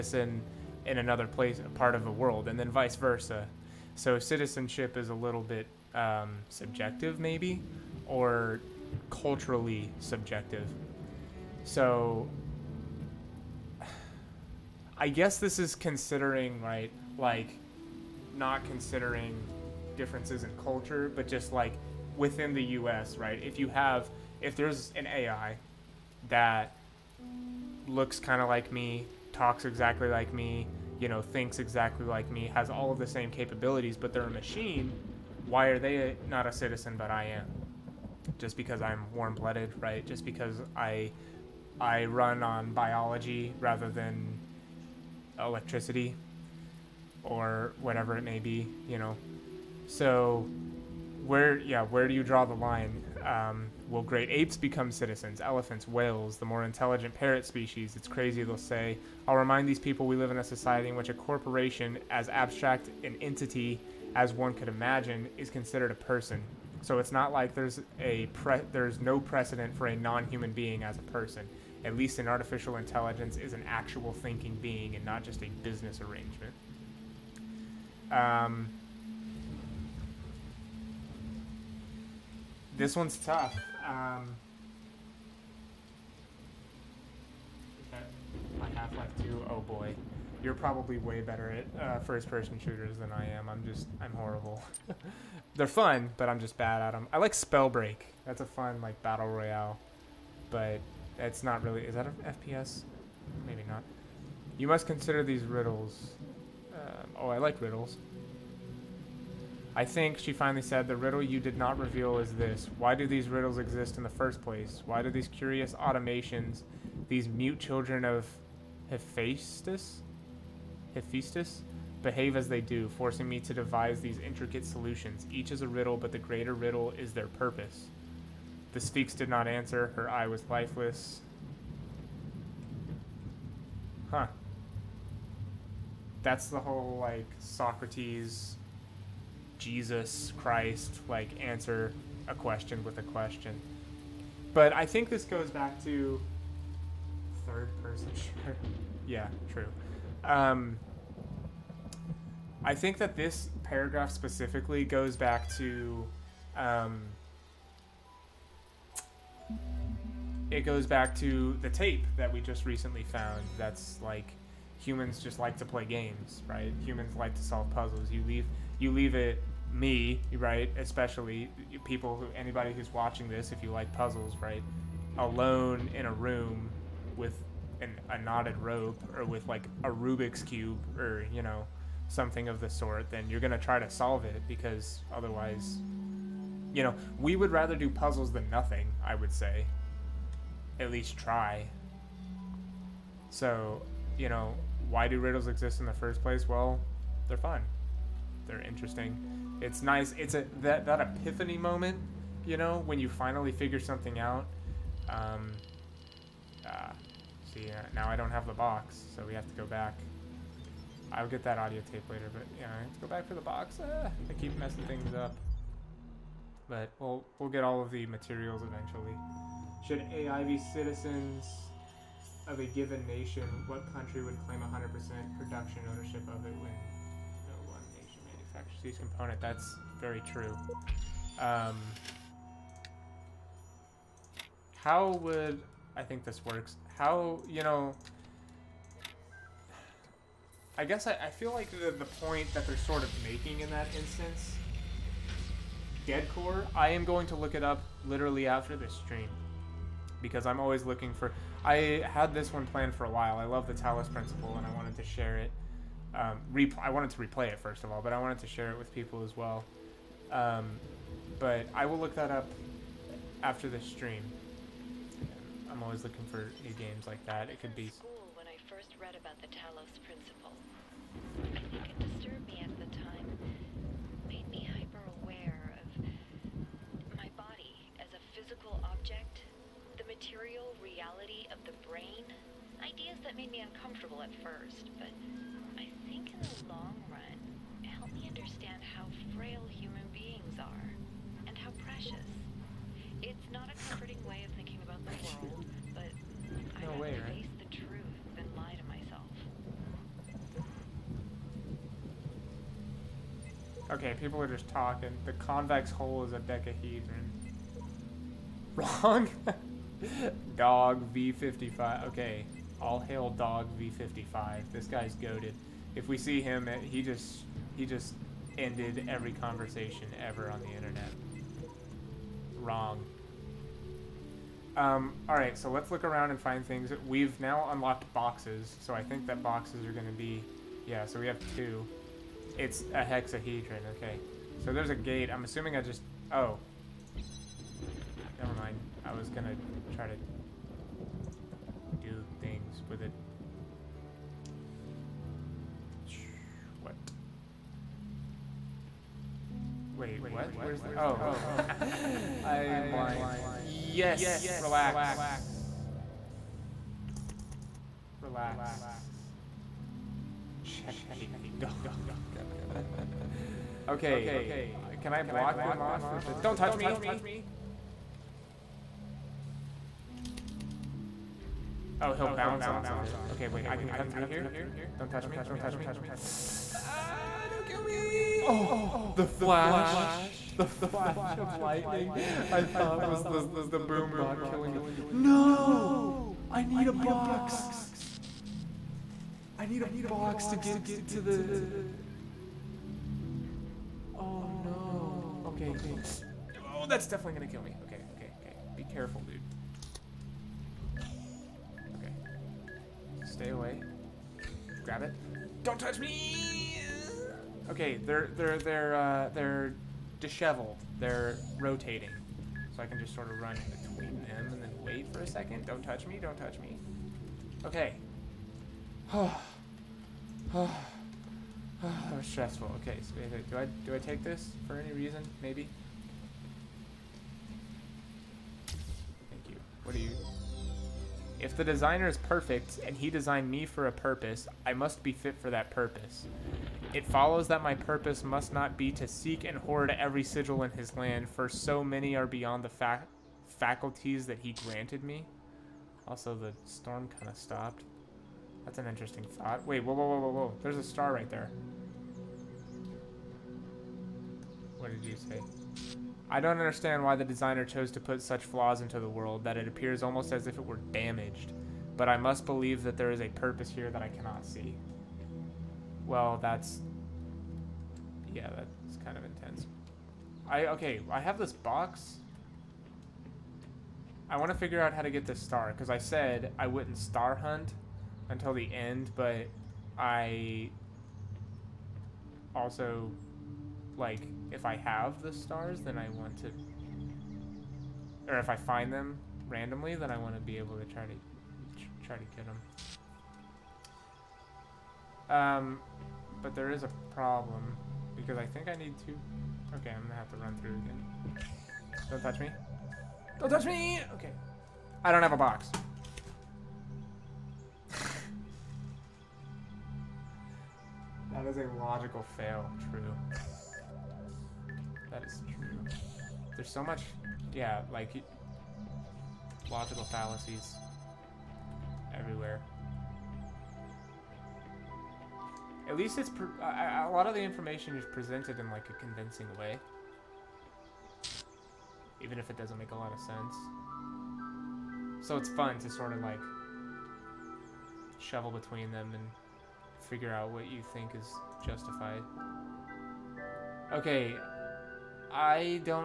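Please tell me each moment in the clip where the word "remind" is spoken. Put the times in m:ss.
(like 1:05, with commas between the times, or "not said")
0:59.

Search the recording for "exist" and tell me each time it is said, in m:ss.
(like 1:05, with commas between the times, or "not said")
1:53, 3:15.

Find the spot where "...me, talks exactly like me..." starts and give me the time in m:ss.
0:28.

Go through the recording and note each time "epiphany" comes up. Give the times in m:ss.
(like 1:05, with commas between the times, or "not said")
3:21.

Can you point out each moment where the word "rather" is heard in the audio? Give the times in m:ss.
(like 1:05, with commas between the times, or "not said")
0:43, 3:07.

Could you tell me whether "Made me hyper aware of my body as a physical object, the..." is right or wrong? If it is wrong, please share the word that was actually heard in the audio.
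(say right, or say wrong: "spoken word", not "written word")
right.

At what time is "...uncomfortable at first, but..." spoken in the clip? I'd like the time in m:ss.
4:43.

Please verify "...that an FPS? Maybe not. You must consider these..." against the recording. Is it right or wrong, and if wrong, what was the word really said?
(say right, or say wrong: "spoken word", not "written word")
right.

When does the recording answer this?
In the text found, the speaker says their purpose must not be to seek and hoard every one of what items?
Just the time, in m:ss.
7:20.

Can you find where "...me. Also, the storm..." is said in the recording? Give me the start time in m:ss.
7:25.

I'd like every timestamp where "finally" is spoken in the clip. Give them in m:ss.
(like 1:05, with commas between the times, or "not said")
1:50, 3:23.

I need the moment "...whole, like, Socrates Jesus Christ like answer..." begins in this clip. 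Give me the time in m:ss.
2:16.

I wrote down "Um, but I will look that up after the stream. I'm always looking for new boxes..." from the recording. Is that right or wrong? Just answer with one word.
wrong.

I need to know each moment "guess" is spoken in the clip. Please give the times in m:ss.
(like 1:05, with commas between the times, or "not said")
0:15, 4:00.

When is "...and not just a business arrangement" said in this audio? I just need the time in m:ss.
1:14.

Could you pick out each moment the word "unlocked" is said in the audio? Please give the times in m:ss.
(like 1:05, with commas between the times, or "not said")
5:27.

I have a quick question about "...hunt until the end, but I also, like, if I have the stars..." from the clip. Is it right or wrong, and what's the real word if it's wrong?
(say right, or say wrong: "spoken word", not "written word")
right.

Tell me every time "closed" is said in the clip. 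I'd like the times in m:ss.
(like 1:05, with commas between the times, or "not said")
not said.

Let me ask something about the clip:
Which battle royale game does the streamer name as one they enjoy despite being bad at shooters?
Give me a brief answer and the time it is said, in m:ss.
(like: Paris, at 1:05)
Spellbreak, at 1:37.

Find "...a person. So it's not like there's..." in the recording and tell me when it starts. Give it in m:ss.
1:05.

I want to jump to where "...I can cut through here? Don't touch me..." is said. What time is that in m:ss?
6:13.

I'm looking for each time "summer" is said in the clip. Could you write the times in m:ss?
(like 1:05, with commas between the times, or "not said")
not said.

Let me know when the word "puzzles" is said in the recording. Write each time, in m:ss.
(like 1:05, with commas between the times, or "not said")
2:47, 2:53, 3:07.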